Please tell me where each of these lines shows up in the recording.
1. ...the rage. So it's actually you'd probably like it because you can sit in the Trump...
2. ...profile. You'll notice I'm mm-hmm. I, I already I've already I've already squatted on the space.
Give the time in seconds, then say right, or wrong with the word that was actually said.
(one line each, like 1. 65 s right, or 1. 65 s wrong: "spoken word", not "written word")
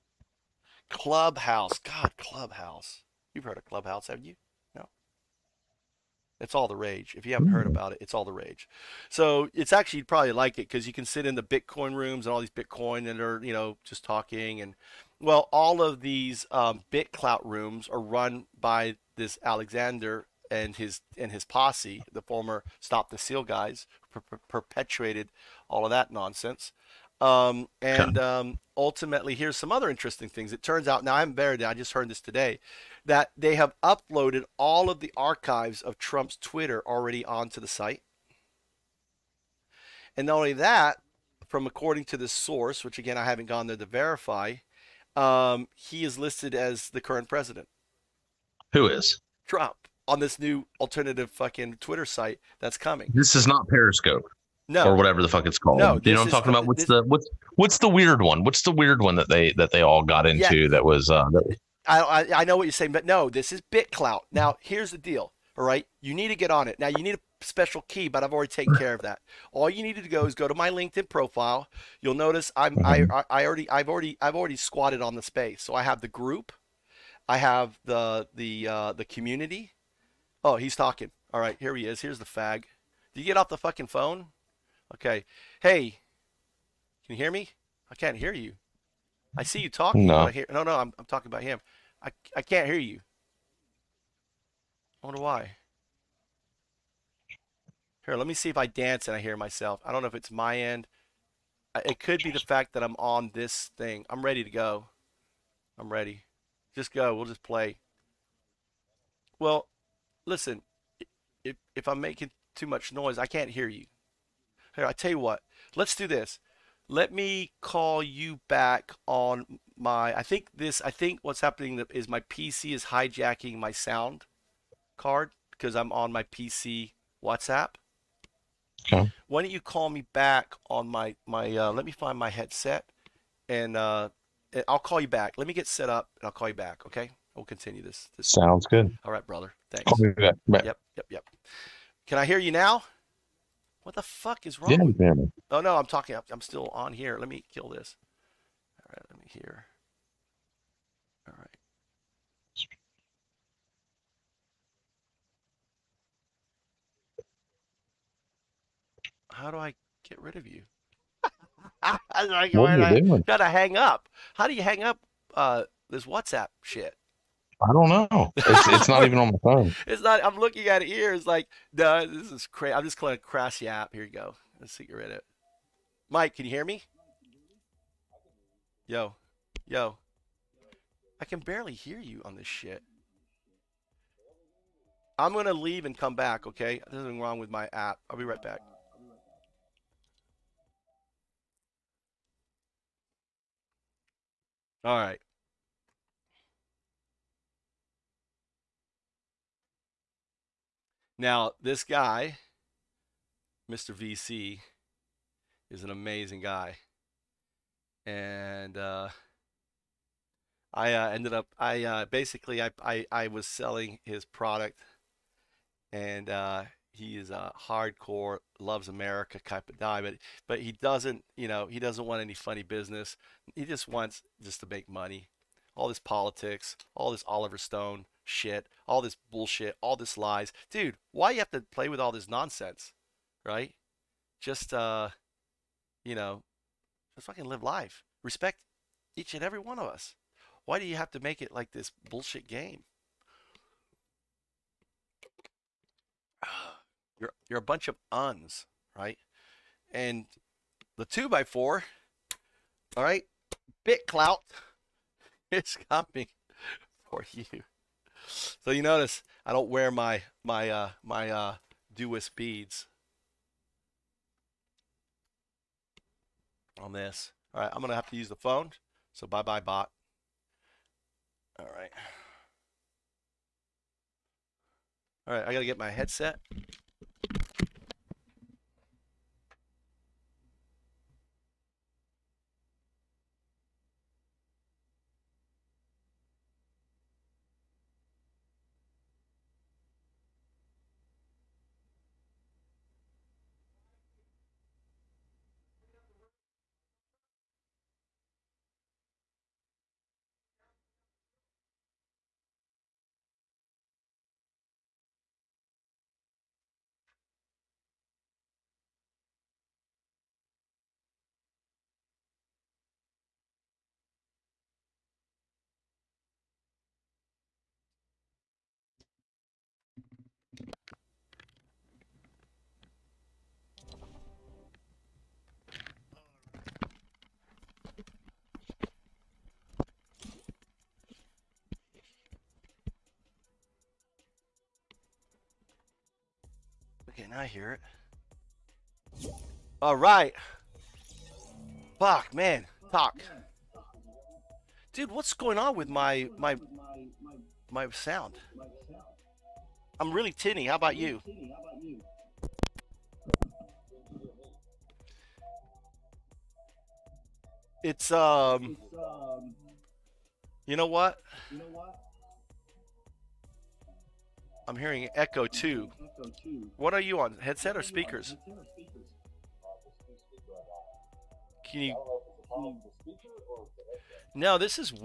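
1. 8 s wrong: "Bitcoin", not "Trump"
2. 71 s right.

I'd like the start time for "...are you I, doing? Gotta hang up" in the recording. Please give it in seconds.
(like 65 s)
162 s.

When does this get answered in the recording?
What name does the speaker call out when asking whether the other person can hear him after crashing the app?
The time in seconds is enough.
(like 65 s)
176 s.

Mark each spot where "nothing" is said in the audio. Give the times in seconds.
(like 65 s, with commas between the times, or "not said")
187 s.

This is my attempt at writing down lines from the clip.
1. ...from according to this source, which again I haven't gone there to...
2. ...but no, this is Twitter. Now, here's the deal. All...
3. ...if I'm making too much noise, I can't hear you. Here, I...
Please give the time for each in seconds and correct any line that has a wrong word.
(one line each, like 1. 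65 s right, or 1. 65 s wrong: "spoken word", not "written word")
1. 41 s right
2. 62 s wrong: "BitClout", not "Twitter"
3. 111 s right.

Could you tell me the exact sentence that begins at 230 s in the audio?
Dude, why you have to play with all this nonsense, right?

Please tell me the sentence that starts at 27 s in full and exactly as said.
Um, and um, ultimately, here's some other interesting things.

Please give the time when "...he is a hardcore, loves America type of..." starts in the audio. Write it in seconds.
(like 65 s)
216 s.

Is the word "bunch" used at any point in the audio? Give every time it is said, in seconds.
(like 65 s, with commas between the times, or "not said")
247 s.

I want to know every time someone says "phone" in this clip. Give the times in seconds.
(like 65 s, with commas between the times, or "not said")
83 s, 169 s, 268 s.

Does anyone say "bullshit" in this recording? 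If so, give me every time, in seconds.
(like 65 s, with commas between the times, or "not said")
229 s, 242 s.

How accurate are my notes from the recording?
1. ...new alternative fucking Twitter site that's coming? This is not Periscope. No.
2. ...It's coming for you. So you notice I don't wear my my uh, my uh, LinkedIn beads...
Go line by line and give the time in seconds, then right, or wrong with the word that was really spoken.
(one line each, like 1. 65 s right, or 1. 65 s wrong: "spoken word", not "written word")
1. 50 s right
2. 255 s wrong: "Dewis", not "LinkedIn".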